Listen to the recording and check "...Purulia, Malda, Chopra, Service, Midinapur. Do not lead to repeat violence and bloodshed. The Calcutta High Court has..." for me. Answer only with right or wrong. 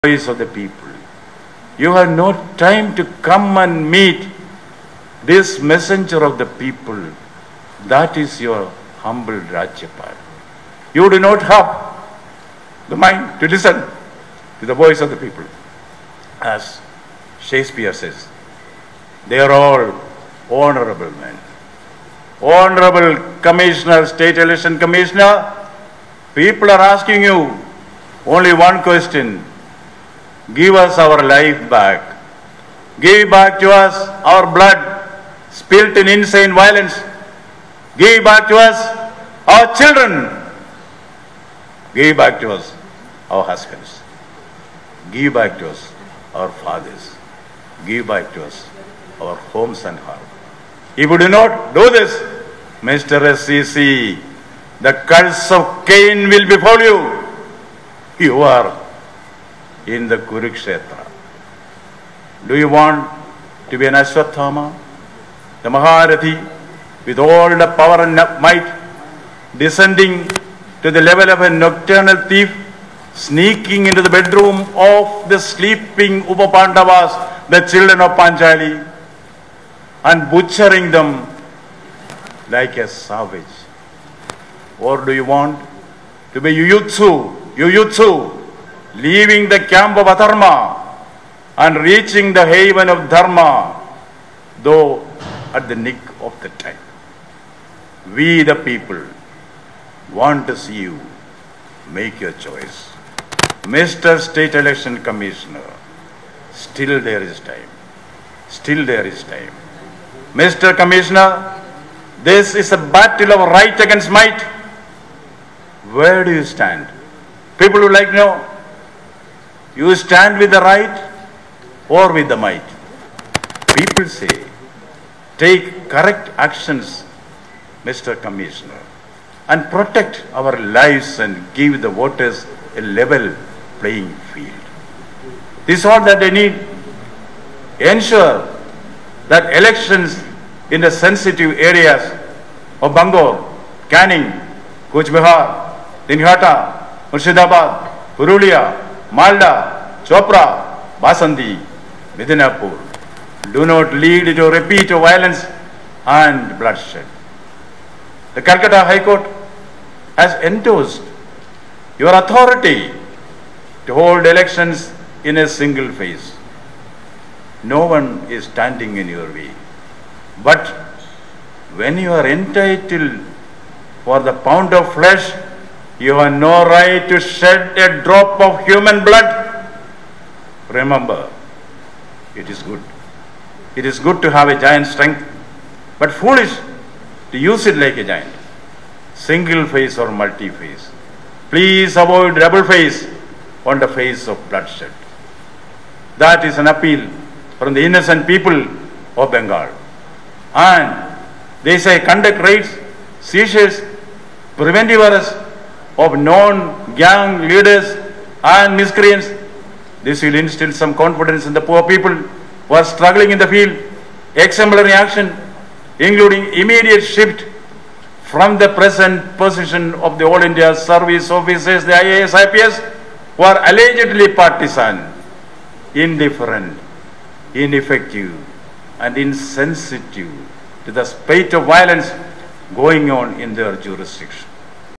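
wrong.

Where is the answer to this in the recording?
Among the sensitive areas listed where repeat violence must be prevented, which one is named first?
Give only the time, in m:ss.
2:22.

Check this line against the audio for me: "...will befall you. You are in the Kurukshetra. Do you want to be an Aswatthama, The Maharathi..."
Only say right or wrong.
right.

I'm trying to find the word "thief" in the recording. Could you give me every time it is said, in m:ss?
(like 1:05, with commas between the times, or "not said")
1:12.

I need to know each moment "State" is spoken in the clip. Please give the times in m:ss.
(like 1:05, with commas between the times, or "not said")
0:24, 1:44.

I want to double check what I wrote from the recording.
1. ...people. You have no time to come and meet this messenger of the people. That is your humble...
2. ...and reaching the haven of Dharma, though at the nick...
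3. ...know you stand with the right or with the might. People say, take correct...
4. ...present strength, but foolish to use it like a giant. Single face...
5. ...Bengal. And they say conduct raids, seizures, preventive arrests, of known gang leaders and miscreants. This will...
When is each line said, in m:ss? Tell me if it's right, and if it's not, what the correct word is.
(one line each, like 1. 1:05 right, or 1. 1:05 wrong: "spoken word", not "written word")
1. 0:00 right
2. 1:31 right
3. 1:58 right
4. 3:04 wrong: "giant", not "present"
5. 3:19 right.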